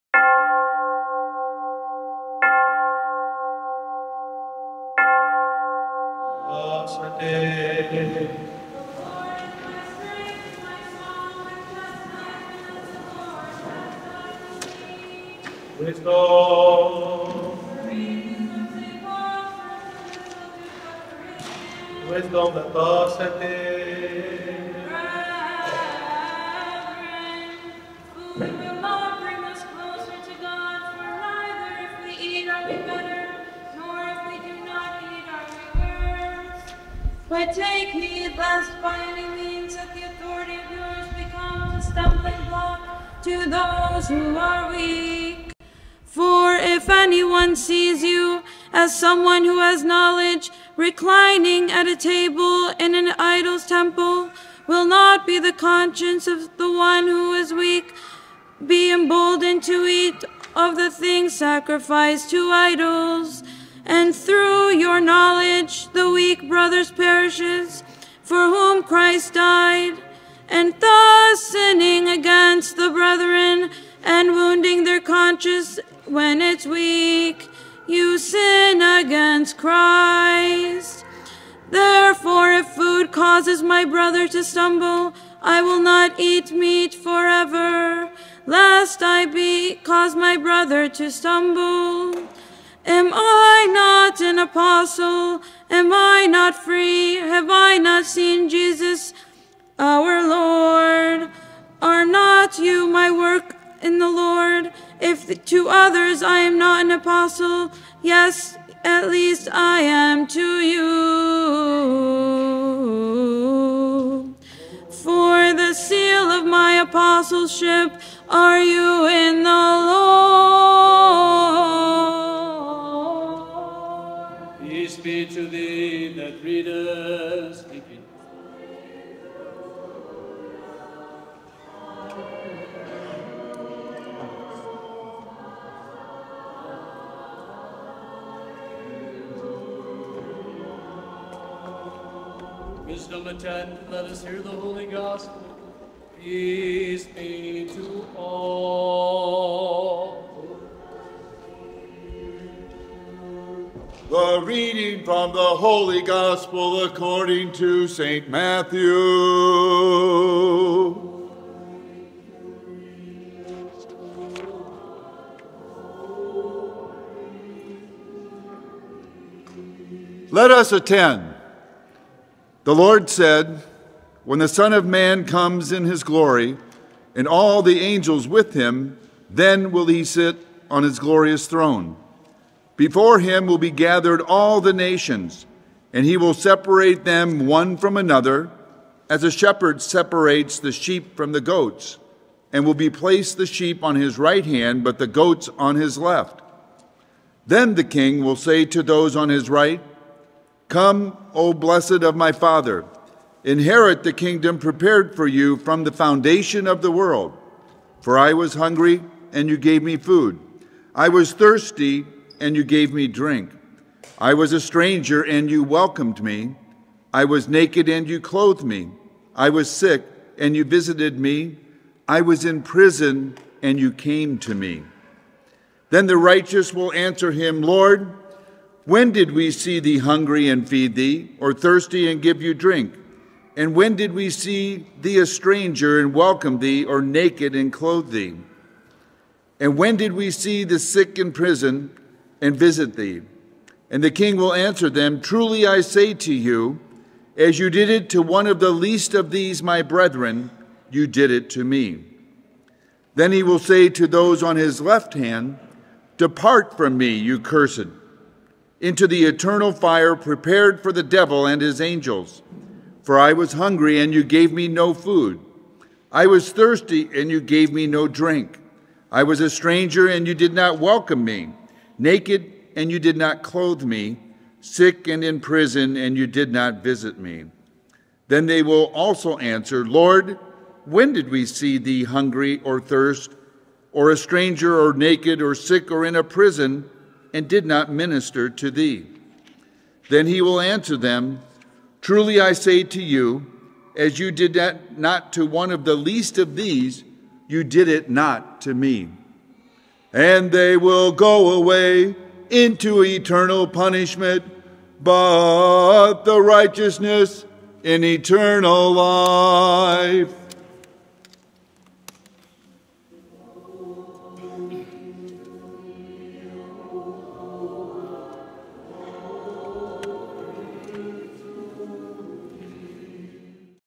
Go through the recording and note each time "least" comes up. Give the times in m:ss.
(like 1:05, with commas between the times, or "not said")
1:49, 4:08, 4:55.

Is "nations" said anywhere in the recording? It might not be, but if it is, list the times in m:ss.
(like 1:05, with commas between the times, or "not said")
3:04.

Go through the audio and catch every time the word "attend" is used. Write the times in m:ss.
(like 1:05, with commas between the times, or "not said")
2:23, 2:50.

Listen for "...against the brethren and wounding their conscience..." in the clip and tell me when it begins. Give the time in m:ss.
1:12.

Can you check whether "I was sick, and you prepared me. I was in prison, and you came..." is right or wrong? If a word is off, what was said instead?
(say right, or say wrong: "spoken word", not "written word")
wrong: "visited", not "prepared".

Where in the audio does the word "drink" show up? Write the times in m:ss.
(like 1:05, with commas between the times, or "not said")
3:33, 3:52, 4:28.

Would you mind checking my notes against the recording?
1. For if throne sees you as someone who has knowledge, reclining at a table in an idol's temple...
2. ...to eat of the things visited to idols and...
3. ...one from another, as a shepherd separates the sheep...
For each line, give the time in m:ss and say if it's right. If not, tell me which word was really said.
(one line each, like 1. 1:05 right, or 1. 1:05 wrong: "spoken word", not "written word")
1. 0:46 wrong: "anyone", not "throne"
2. 0:59 wrong: "sacrificed", not "visited"
3. 3:07 right.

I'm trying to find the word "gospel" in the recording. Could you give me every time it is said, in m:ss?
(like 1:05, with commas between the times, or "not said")
2:24, 2:36.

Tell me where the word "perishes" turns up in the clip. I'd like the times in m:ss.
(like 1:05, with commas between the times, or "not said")
1:06.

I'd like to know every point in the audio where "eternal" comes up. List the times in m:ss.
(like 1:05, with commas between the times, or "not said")
4:19, 5:03, 5:08.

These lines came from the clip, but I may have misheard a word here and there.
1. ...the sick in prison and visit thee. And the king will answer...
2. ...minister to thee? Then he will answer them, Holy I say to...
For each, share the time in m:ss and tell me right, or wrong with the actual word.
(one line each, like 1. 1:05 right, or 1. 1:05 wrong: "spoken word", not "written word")
1. 4:00 right
2. 4:47 wrong: "Truly", not "Holy".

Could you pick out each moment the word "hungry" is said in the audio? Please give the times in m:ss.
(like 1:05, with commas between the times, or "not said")
3:28, 3:49, 4:23, 4:42.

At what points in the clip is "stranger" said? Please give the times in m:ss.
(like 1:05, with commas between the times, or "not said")
3:34, 3:55, 4:29, 4:44.